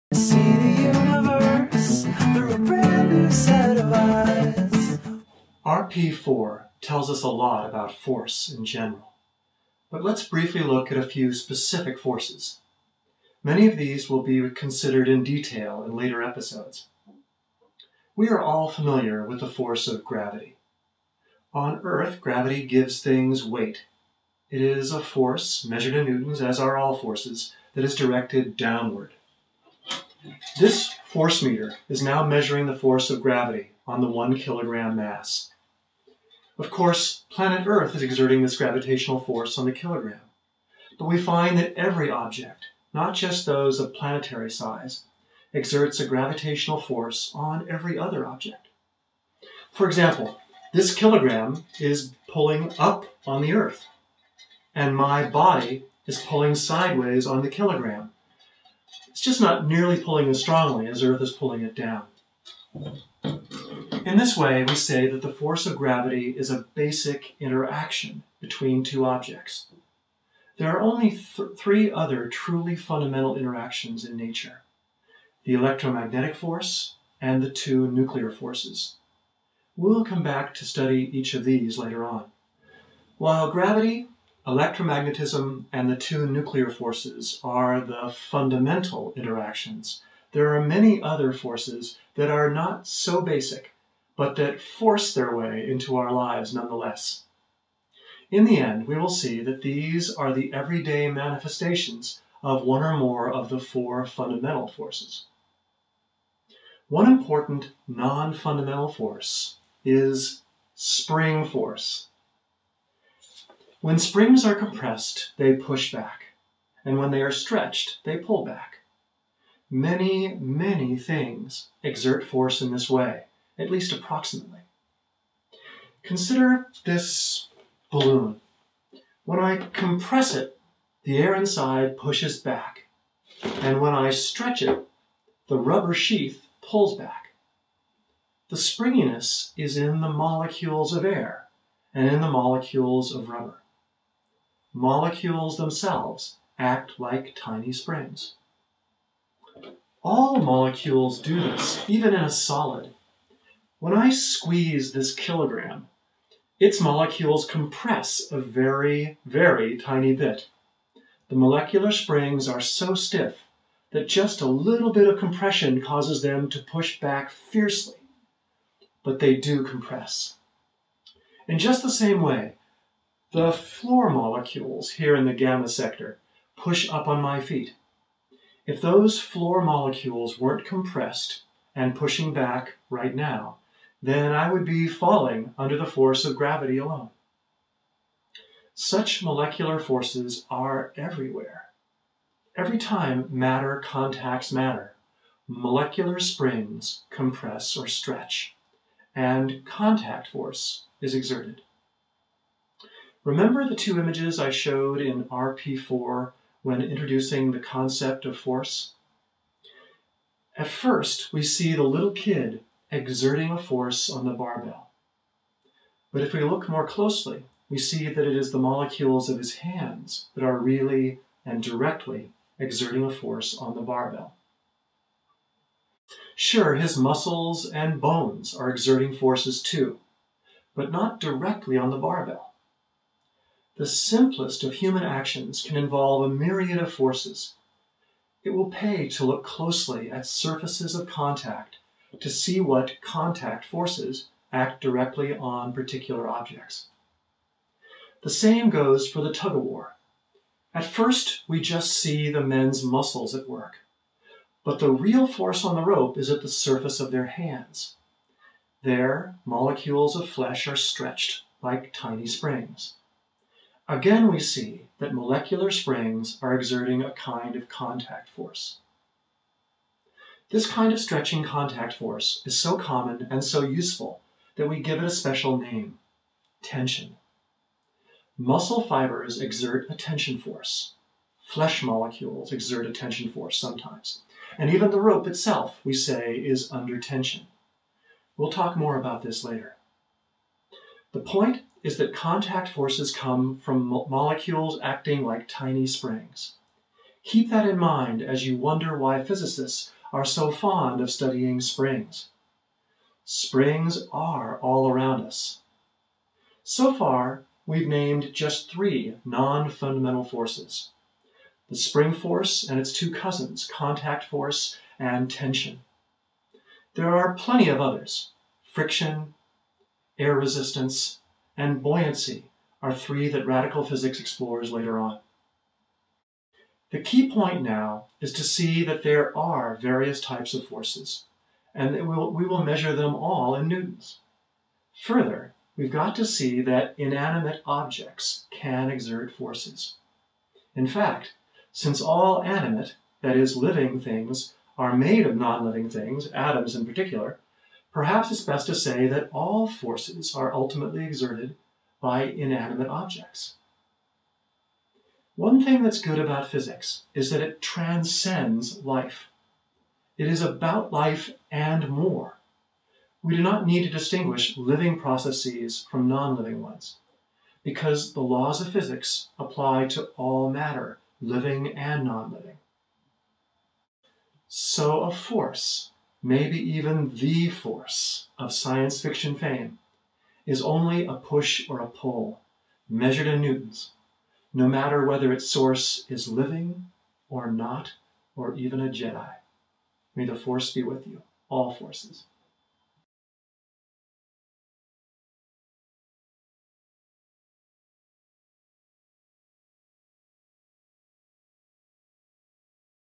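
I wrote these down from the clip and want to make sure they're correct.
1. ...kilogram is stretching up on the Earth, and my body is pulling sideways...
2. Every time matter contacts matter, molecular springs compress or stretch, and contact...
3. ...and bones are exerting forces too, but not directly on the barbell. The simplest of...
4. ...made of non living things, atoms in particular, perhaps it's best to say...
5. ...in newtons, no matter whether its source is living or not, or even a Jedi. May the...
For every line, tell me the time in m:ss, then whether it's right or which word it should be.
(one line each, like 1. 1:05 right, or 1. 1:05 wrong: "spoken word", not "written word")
1. 0:50 wrong: "pulling", not "stretching"
2. 3:12 right
3. 3:47 right
4. 5:44 right
5. 6:23 right.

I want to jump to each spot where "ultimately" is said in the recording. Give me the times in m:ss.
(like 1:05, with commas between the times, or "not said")
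5:50.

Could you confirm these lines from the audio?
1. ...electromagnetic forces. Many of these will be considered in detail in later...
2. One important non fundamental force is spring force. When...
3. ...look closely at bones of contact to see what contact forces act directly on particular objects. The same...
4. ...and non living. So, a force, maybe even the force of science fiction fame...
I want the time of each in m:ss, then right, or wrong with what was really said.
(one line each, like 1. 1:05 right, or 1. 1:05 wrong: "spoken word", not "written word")
1. 0:11 wrong: "specific", not "electromagnetic"
2. 1:46 right
3. 3:59 wrong: "surfaces", not "bones"
4. 6:11 right.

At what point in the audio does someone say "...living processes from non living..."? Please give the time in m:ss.
6:04.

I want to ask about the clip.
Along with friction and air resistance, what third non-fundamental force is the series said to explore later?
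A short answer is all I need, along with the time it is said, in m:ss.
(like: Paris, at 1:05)
Buoyancy, at 5:21.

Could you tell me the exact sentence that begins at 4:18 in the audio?
There, molecules of flesh are stretched like tiny springs.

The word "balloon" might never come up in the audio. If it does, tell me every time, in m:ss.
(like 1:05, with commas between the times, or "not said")
2:07.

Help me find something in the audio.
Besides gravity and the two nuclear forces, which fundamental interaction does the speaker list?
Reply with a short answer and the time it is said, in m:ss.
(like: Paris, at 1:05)
Electromagnetic force, at 1:15.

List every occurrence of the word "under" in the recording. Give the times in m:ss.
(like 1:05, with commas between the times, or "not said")
3:05, 4:46.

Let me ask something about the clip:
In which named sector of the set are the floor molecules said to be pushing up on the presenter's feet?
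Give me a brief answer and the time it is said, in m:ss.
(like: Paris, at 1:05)
Gamma sector, at 2:55.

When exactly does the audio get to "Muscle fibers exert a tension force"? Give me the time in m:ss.
4:38.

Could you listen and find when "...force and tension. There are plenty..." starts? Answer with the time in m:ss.
5:14.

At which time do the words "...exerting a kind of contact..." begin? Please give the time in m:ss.
4:26.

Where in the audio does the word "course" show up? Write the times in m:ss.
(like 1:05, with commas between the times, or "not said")
0:36.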